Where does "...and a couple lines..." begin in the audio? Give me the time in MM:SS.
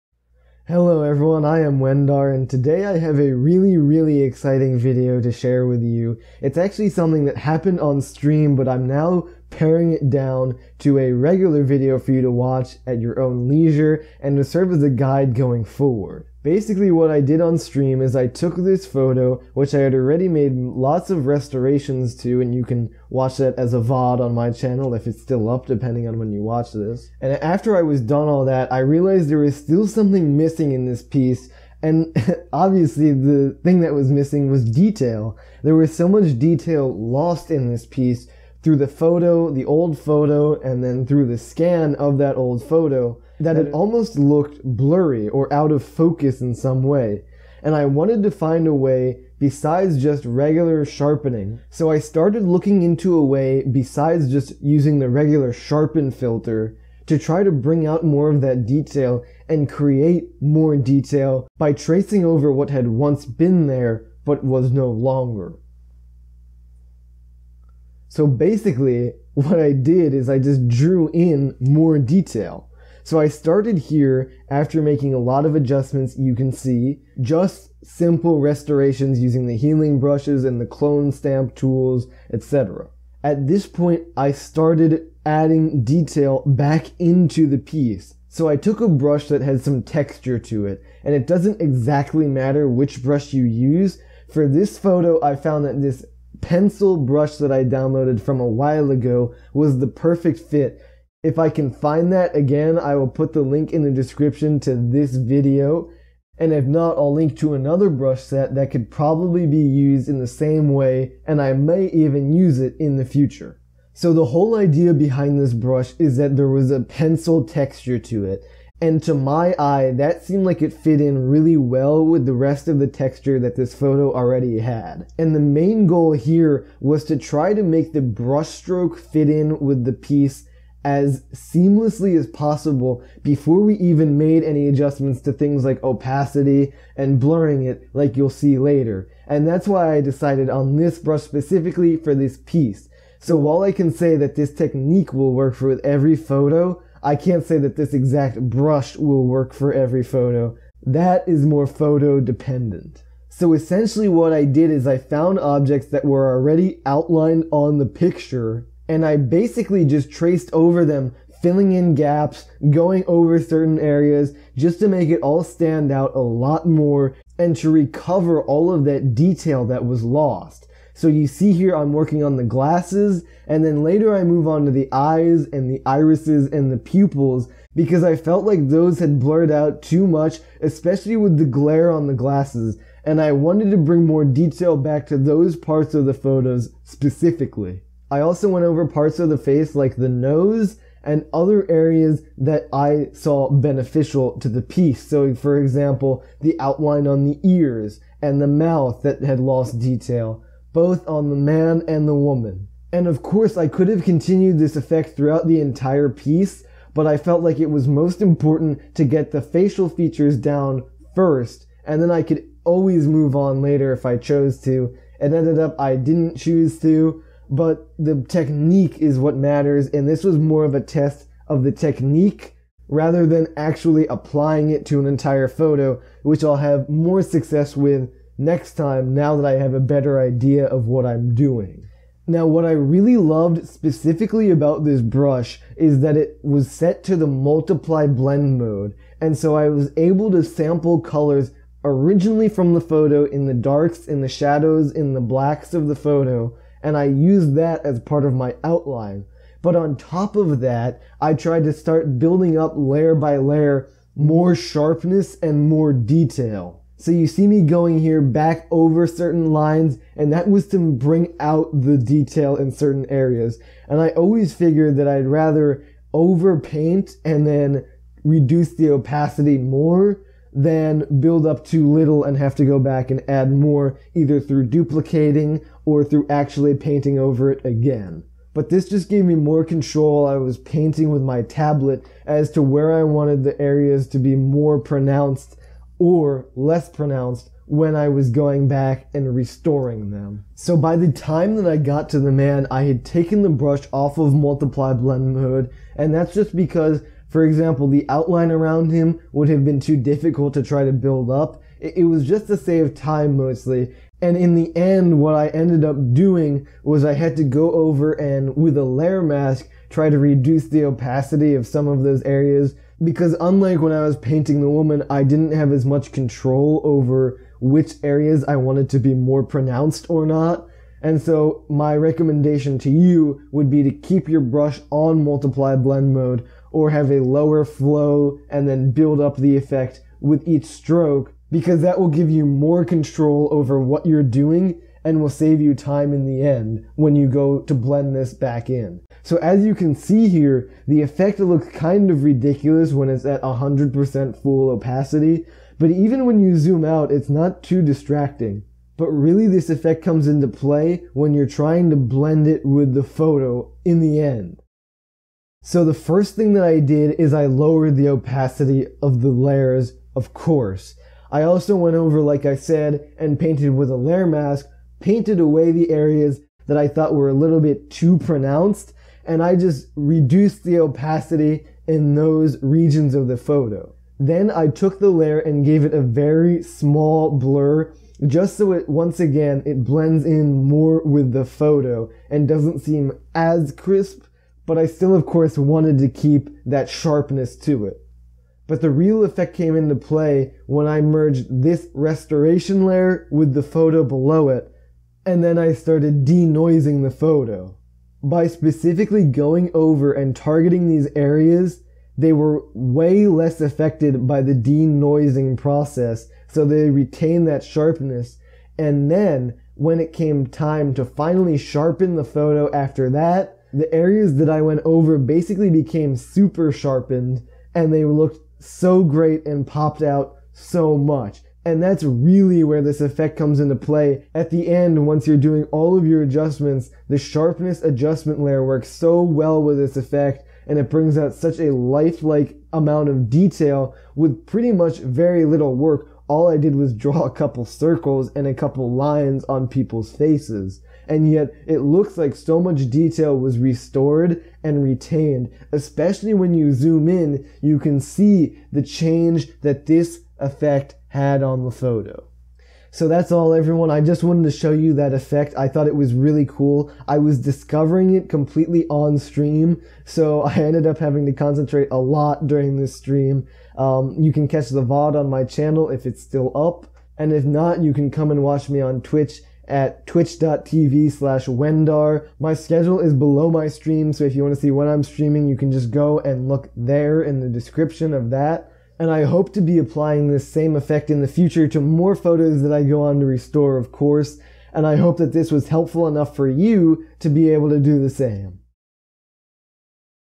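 07:18.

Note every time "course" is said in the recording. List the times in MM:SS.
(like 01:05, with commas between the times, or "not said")
03:23, 06:00, 06:25, 08:03.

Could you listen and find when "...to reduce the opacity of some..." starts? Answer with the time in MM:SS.
05:10.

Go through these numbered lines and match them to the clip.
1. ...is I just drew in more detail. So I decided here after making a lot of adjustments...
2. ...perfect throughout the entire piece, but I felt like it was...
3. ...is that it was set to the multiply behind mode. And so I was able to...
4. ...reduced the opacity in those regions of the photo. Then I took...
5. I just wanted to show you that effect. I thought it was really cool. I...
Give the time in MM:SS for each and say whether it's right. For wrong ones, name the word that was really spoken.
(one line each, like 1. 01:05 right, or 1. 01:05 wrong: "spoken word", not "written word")
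1. 01:10 wrong: "started", not "decided"
2. 03:24 wrong: "effect", not "perfect"
3. 03:55 wrong: "blend", not "behind"
4. 06:09 right
5. 07:33 right.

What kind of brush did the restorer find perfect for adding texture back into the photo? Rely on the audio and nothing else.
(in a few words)
pencil brush.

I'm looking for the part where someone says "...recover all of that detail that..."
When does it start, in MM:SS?
02:47.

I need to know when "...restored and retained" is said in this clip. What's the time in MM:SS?
07:23.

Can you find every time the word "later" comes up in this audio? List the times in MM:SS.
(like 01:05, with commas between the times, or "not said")
02:18, 02:53, 03:33.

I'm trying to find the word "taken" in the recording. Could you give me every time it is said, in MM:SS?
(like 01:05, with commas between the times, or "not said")
04:53.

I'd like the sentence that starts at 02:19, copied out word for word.
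And that's why I decided on this brush specifically for this piece.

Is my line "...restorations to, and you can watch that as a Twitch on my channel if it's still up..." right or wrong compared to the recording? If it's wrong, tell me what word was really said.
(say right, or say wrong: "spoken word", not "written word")
wrong: "VOD", not "Twitch".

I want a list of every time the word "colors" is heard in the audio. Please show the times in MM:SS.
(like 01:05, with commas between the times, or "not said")
04:01.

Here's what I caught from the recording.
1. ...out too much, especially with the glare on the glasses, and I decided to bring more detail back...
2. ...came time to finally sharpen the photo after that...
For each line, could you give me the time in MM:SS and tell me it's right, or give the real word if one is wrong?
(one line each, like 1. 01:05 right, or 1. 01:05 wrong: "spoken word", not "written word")
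1. 02:59 wrong: "wanted", not "decided"
2. 06:50 right.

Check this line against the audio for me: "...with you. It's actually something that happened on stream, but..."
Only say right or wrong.
right.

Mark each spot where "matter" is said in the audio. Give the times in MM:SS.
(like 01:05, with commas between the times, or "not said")
01:32, 03:39.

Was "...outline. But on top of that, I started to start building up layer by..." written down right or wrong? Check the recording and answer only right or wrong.
wrong.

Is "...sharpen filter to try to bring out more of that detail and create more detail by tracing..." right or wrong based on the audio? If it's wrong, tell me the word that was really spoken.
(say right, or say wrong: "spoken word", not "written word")
right.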